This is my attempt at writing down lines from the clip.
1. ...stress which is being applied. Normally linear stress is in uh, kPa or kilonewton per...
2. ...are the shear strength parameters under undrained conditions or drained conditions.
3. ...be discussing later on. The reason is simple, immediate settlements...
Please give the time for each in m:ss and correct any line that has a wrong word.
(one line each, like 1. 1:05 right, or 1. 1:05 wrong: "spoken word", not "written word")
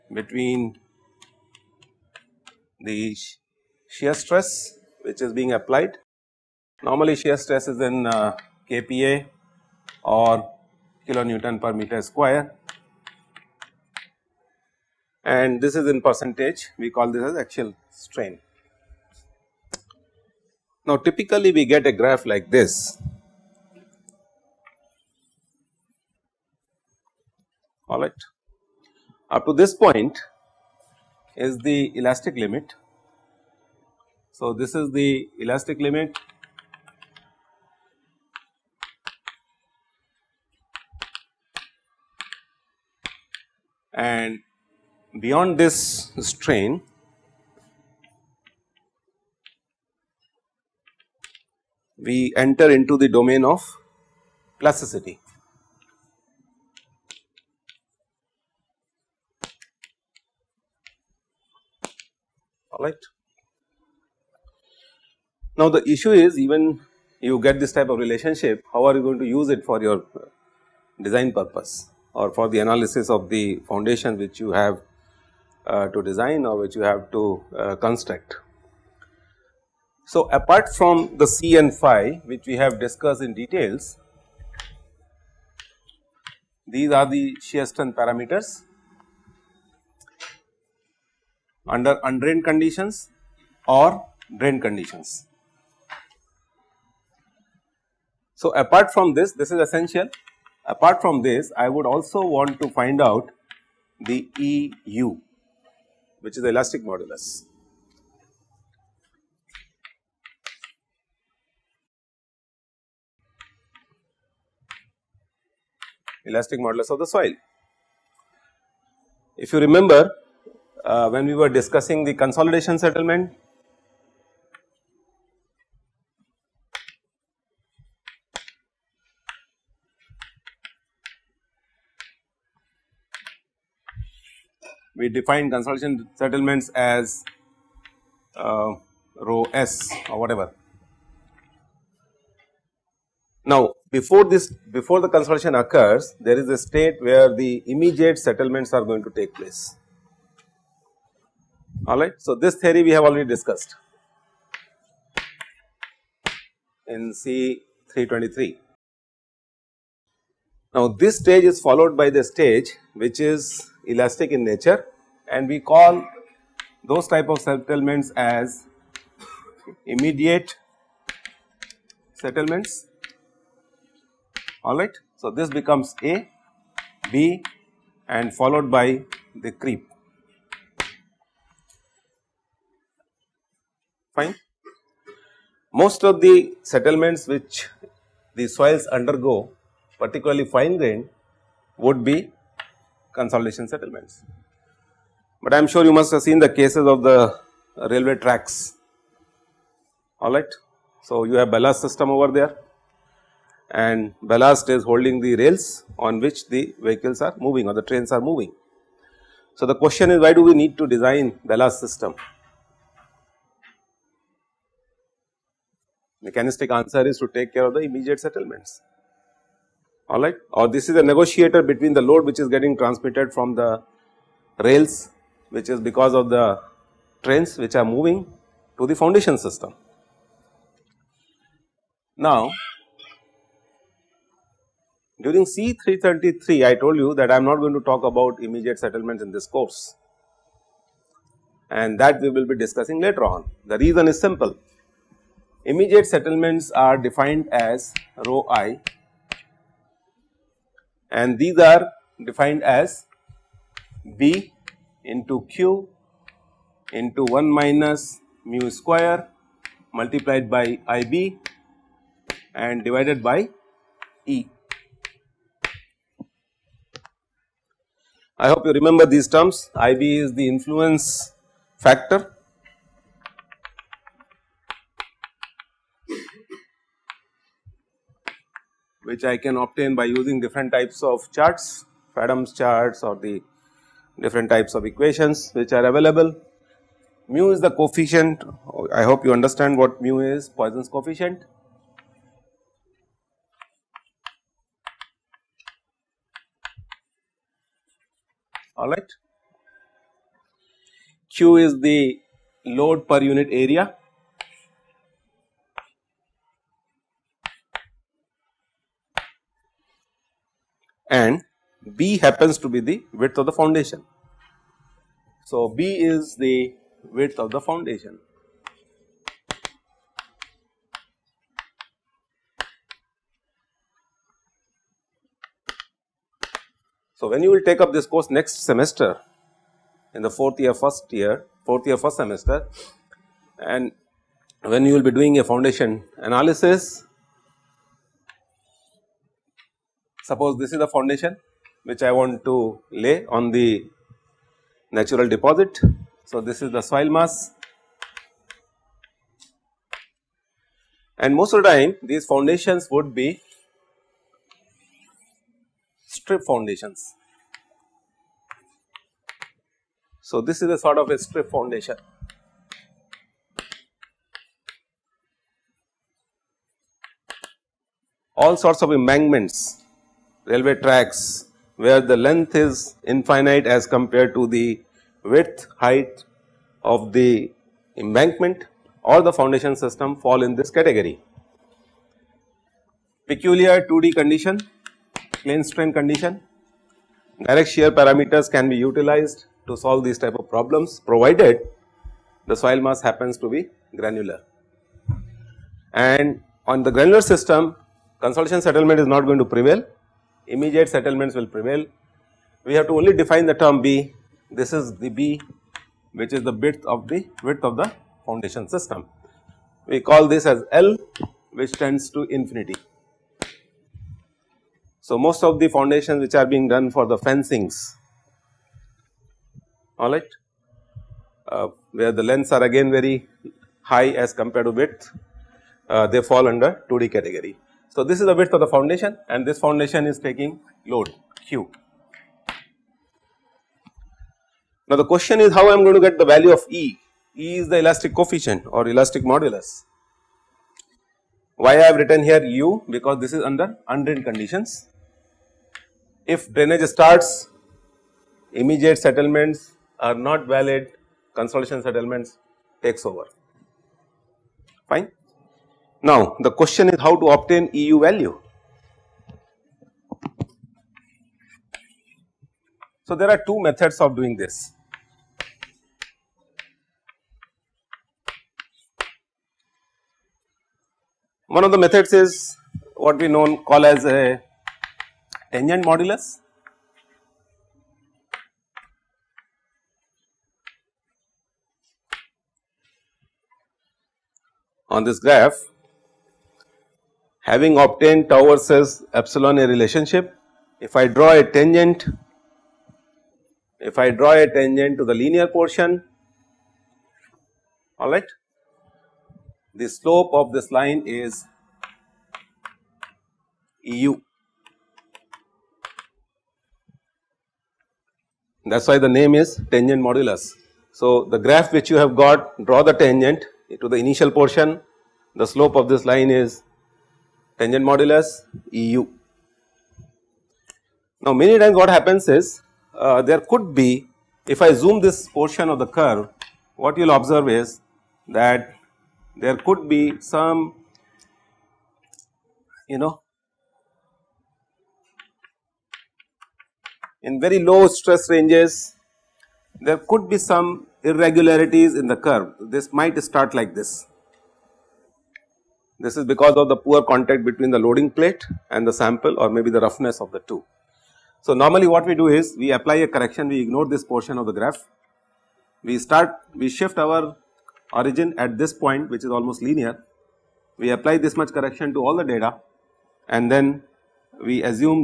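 1. 0:04 wrong: "shear", not "linear"
2. 1:26 right
3. 4:02 right.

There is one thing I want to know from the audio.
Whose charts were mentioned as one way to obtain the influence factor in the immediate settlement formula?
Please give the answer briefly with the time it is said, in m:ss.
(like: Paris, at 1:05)
Fadum's charts, at 4:42.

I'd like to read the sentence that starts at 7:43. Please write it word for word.
So there are two methods of doing this.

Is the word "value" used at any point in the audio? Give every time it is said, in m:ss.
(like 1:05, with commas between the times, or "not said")
7:16, 7:38.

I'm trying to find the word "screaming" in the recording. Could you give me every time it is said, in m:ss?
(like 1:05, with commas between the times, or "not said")
not said.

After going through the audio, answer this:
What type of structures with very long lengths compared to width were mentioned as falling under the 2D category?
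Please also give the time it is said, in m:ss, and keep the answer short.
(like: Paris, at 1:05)
Fencings, at 6:57.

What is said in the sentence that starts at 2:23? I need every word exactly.
Now before this before the consolidation occurs there is a state where the immediate settlements are going to take place alright.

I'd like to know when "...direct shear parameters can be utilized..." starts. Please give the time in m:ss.
6:27.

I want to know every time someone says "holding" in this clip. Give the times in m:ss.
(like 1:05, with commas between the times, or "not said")
3:24.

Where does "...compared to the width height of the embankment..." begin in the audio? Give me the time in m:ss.
6:13.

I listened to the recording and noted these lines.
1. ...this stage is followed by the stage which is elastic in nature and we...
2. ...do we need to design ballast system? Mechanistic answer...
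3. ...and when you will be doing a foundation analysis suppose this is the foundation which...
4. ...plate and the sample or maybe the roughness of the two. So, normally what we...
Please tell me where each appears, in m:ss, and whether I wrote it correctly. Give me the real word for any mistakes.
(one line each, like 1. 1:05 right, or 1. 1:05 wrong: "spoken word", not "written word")
1. 2:41 right
2. 3:30 right
3. 5:33 right
4. 9:08 right.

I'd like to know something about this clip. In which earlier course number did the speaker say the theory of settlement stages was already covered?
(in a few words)
C 323.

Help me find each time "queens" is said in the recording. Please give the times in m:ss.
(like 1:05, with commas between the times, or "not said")
not said.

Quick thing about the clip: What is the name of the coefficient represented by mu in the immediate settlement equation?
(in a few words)
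Poisson's coefficient.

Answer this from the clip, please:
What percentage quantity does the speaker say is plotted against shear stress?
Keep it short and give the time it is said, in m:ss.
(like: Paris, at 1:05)
Axial strain, at 0:17.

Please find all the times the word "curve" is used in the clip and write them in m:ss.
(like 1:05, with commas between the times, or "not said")
8:45, 9:02.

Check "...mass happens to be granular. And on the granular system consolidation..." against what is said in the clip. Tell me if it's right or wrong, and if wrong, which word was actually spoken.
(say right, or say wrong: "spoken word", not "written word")
right.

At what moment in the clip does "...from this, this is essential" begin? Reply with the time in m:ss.
1:38.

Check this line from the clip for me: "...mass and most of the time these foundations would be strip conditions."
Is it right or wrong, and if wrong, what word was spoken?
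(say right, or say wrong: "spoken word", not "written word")
wrong: "foundations", not "conditions".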